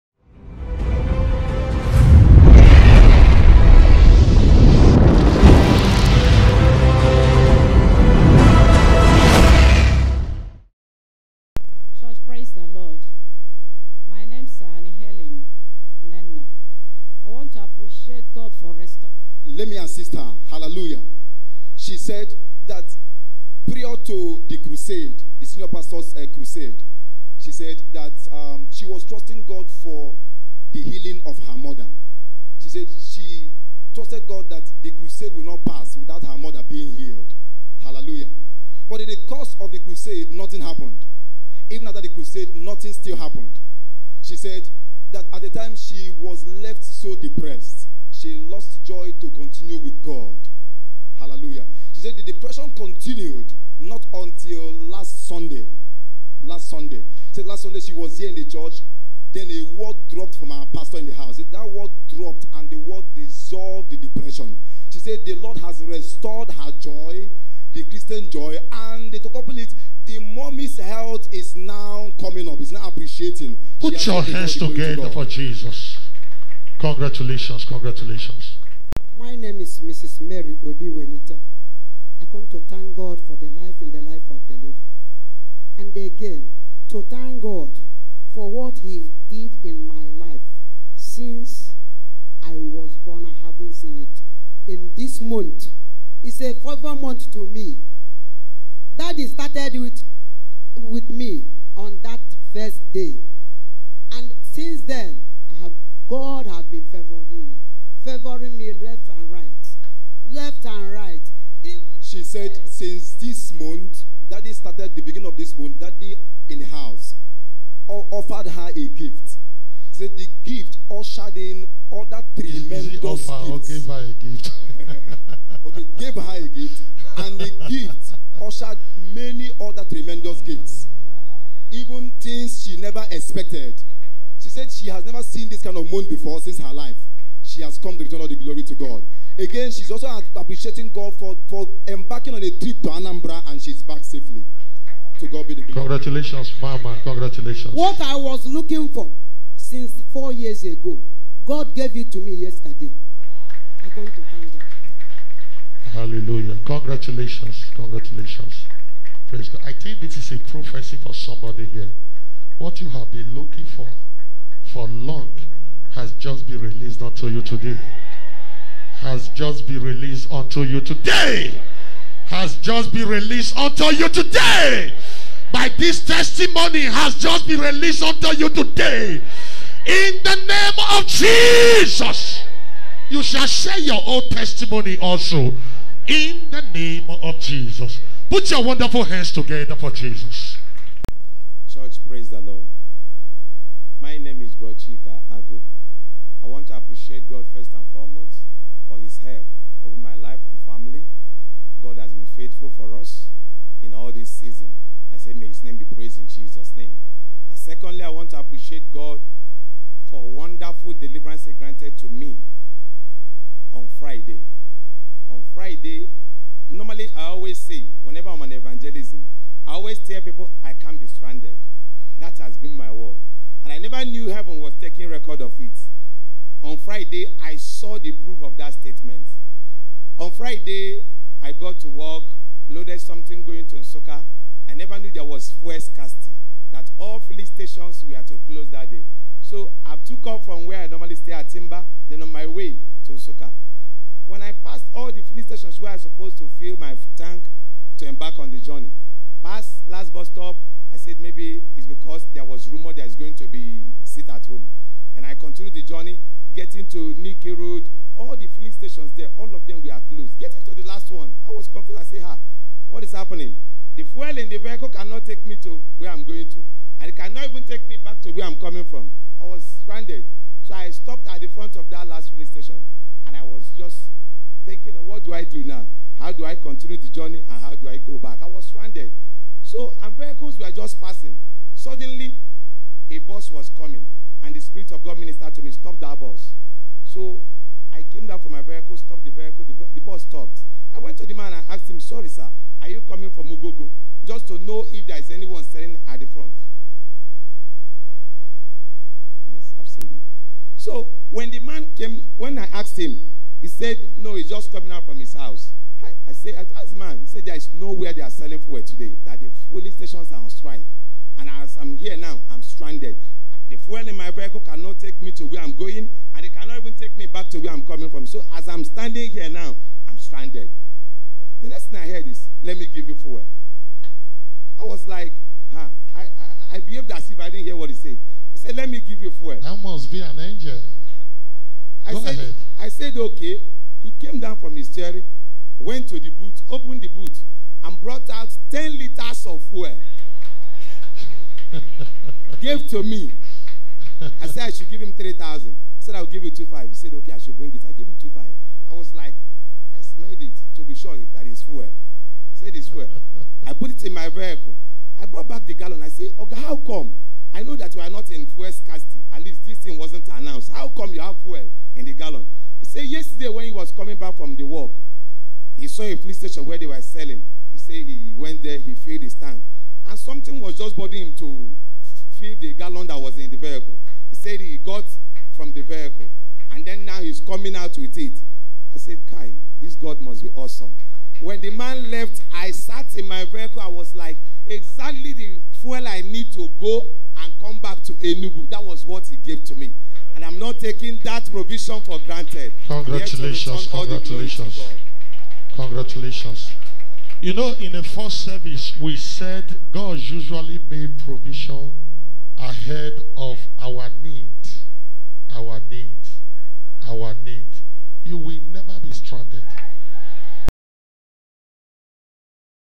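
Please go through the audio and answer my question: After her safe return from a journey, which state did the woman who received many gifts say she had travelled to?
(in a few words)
Anambra.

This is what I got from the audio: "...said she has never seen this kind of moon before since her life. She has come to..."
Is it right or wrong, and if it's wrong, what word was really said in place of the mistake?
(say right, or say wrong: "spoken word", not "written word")
right.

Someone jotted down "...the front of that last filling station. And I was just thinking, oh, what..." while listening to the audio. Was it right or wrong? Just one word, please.
right.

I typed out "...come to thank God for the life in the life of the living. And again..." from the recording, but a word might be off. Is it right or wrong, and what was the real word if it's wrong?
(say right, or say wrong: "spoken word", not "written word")
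right.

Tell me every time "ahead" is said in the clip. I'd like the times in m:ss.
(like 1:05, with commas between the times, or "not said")
5:32, 6:42.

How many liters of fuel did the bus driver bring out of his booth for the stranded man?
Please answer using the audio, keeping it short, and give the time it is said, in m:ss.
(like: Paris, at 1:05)
10, at 5:38.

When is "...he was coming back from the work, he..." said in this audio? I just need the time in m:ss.
6:03.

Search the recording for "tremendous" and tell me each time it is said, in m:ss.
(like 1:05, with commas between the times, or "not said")
2:02, 2:09.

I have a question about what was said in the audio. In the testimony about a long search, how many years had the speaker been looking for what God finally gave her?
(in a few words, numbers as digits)
4.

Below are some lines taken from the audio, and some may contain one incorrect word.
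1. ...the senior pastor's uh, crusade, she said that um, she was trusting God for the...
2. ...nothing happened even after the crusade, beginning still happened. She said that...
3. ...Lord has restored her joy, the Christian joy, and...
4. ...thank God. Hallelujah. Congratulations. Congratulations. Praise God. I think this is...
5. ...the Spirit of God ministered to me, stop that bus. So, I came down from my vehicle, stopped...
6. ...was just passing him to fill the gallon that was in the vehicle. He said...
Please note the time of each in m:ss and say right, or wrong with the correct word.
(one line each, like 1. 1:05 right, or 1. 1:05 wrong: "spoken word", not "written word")
1. 0:25 right
2. 0:40 wrong: "nothing", not "beginning"
3. 1:05 right
4. 2:34 right
5. 4:44 right
6. 6:10 wrong: "bothering", not "passing".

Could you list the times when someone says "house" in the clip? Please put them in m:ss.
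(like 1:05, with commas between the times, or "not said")
1:01, 1:56, 5:05.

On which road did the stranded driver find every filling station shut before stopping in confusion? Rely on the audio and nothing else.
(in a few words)
Nike Road.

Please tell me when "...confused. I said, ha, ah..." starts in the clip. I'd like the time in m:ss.
4:21.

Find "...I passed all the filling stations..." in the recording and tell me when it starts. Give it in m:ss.
4:04.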